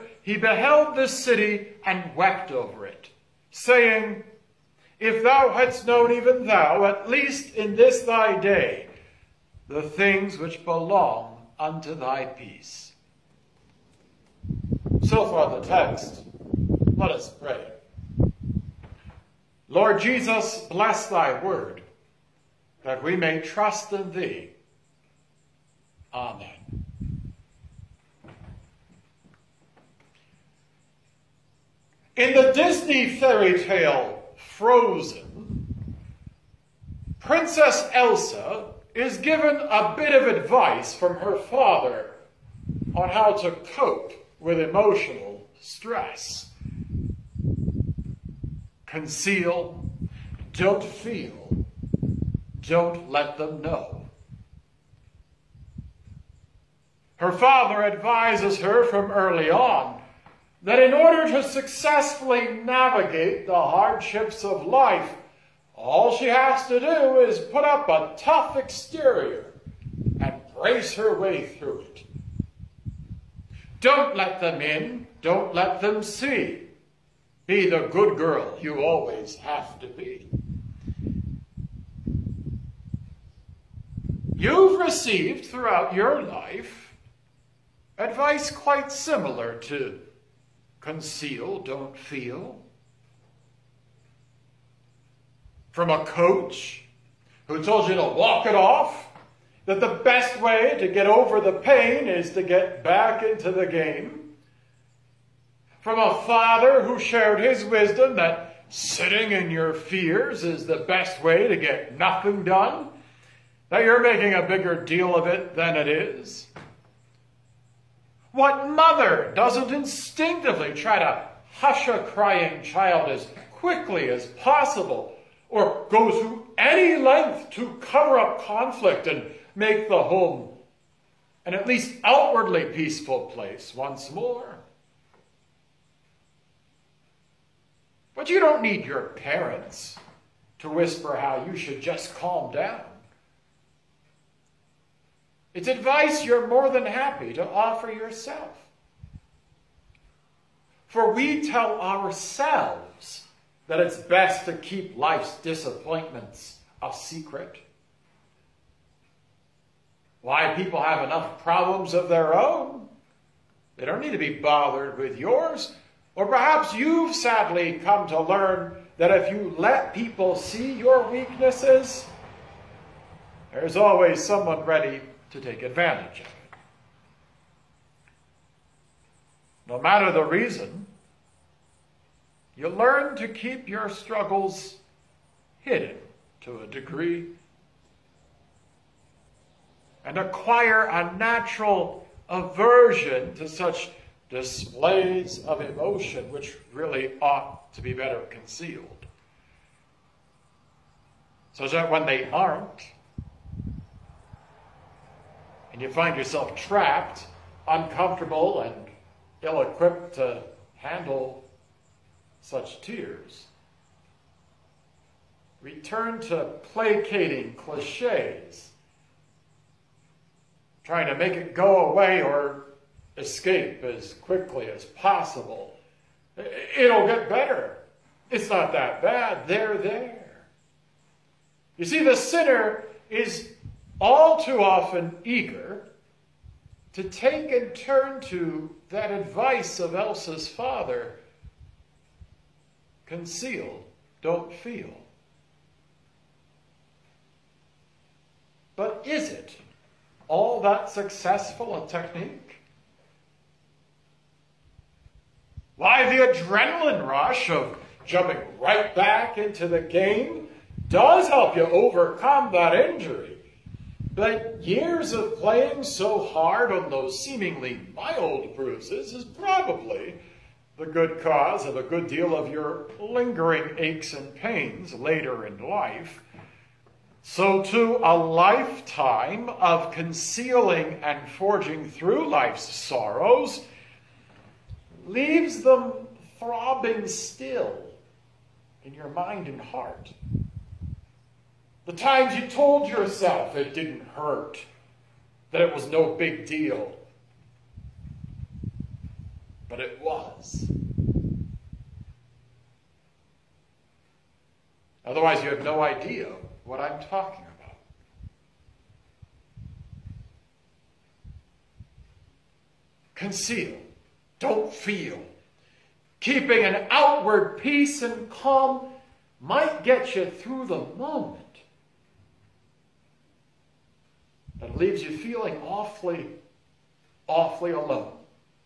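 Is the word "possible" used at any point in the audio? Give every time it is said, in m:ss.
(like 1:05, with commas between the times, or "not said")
2:04, 3:44.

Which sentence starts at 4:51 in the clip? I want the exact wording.
The times you told yourself it didn't hurt, that it was no big deal.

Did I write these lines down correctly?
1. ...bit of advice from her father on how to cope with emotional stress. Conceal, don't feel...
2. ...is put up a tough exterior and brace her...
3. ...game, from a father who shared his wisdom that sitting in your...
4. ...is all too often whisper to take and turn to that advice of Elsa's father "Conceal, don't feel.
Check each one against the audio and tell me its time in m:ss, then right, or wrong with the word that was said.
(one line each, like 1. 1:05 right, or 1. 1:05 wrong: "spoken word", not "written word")
1. 0:39 right
2. 1:07 right
3. 1:43 right
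4. 3:53 wrong: "eager", not "whisper".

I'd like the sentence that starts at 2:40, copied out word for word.
Why, people have enough problems of their own.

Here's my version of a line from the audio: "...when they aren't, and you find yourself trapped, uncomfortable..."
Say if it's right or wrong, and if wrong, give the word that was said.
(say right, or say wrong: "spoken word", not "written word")
right.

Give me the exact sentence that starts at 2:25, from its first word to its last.
It's advice you're more than happy to offer yourself.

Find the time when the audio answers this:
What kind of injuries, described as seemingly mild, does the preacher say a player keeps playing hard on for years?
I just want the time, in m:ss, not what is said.
4:28.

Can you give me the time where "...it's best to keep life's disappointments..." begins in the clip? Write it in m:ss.
2:33.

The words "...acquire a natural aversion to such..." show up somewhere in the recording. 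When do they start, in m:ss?
3:10.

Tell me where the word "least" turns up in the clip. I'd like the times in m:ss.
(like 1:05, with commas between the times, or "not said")
0:07, 2:11.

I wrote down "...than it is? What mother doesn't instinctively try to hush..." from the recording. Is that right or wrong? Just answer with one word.
right.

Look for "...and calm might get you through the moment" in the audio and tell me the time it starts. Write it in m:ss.
5:18.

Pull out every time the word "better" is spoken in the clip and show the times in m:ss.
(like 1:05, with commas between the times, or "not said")
3:17, 3:47.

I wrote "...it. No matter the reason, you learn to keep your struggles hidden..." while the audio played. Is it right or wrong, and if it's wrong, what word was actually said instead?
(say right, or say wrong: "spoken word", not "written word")
right.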